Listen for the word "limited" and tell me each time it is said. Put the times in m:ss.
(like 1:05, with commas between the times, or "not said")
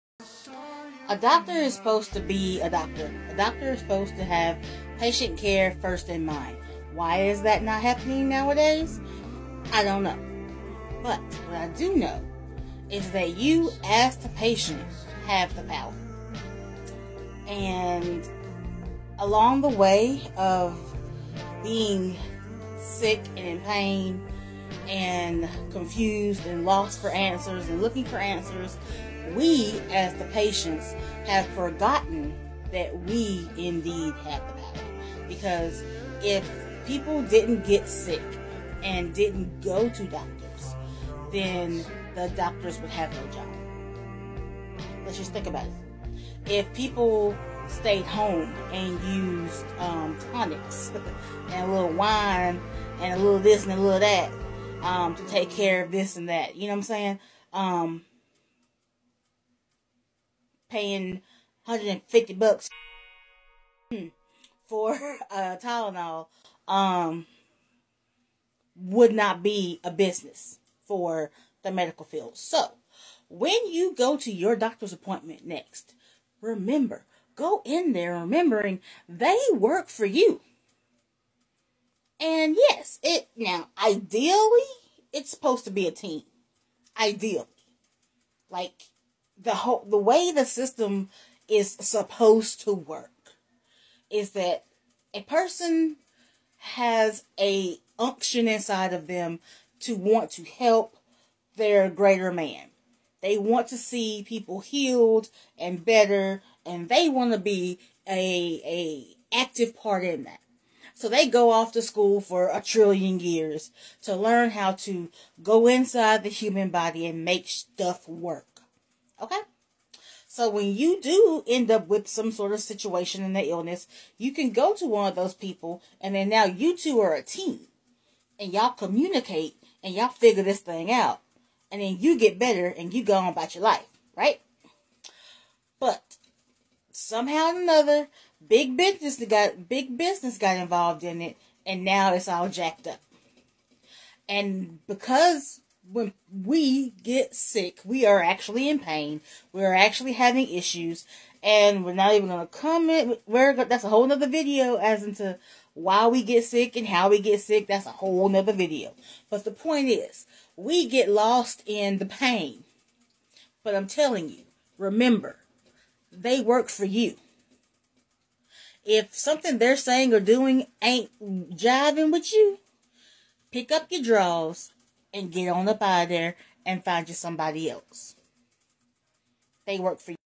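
not said.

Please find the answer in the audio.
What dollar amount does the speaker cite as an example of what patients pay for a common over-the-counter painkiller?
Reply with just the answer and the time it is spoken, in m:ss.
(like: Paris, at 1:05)
$150, at 1:01.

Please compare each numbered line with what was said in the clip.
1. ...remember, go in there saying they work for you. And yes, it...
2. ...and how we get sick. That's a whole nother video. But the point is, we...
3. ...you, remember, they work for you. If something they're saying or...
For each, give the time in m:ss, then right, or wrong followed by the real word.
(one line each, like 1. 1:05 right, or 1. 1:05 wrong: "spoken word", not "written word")
1. 1:16 wrong: "remembering", not "saying"
2. 2:36 right
3. 2:44 right.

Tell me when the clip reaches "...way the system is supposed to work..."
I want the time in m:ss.
1:29.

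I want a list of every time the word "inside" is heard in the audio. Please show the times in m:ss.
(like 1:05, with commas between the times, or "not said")
1:38, 1:55.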